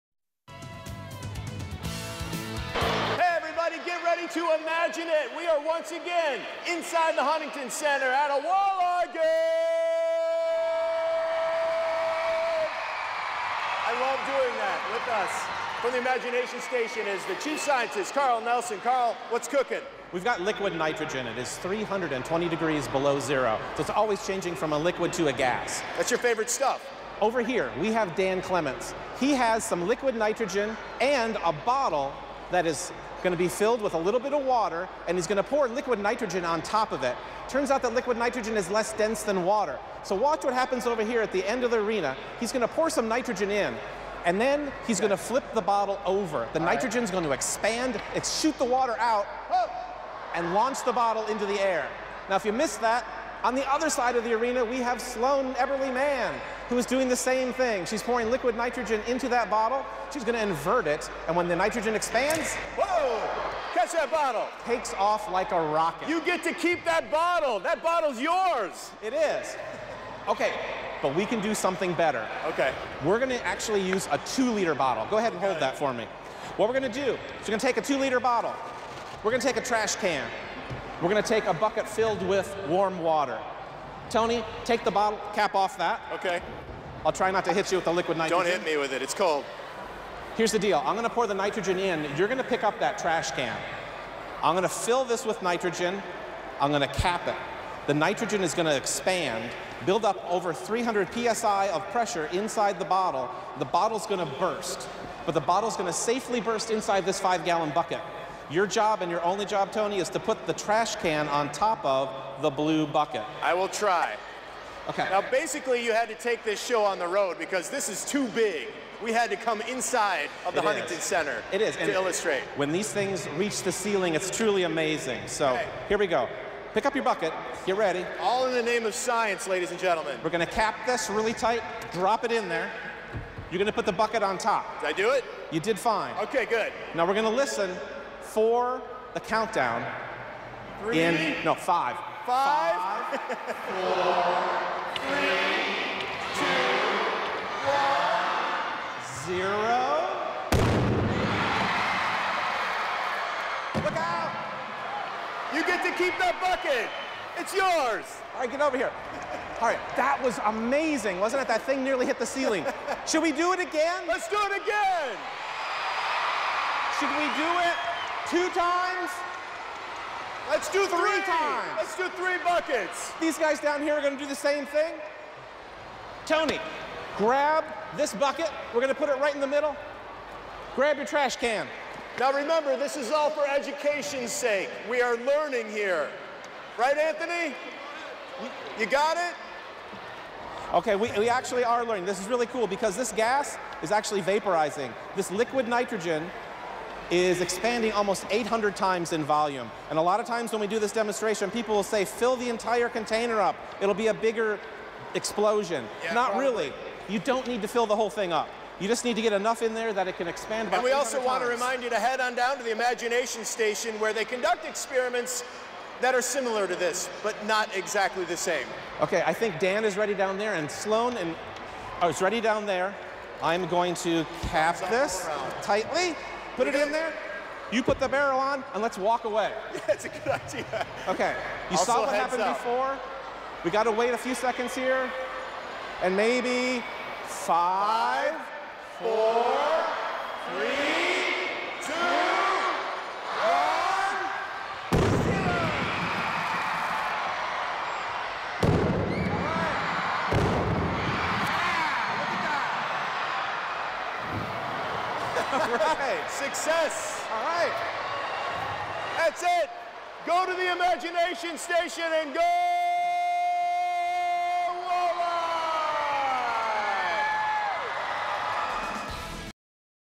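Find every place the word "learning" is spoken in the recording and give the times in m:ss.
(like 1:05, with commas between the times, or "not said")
3:05, 3:11.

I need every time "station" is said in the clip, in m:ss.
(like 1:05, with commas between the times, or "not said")
0:16, 3:33, 4:21.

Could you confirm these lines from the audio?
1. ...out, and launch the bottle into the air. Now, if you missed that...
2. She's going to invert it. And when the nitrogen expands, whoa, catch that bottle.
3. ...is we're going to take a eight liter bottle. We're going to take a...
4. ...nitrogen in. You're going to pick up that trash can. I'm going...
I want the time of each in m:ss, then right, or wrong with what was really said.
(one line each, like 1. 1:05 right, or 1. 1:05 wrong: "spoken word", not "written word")
1. 0:48 right
2. 1:00 right
3. 1:17 wrong: "two", not "eight"
4. 1:31 right.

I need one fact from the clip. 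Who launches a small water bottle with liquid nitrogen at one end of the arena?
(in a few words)
Dan Clements.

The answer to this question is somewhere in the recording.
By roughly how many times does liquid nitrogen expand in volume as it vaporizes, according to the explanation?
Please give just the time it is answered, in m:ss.
3:18.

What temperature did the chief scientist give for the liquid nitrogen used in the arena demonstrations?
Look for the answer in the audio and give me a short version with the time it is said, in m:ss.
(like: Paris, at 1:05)
320 degrees below zero, at 0:21.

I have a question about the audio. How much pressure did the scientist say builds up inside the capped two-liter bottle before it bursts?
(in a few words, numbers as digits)
Over 300 psi.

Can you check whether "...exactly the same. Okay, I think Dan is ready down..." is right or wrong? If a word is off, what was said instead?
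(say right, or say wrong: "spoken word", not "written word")
right.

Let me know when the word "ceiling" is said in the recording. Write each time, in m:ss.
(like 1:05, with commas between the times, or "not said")
2:03, 2:42.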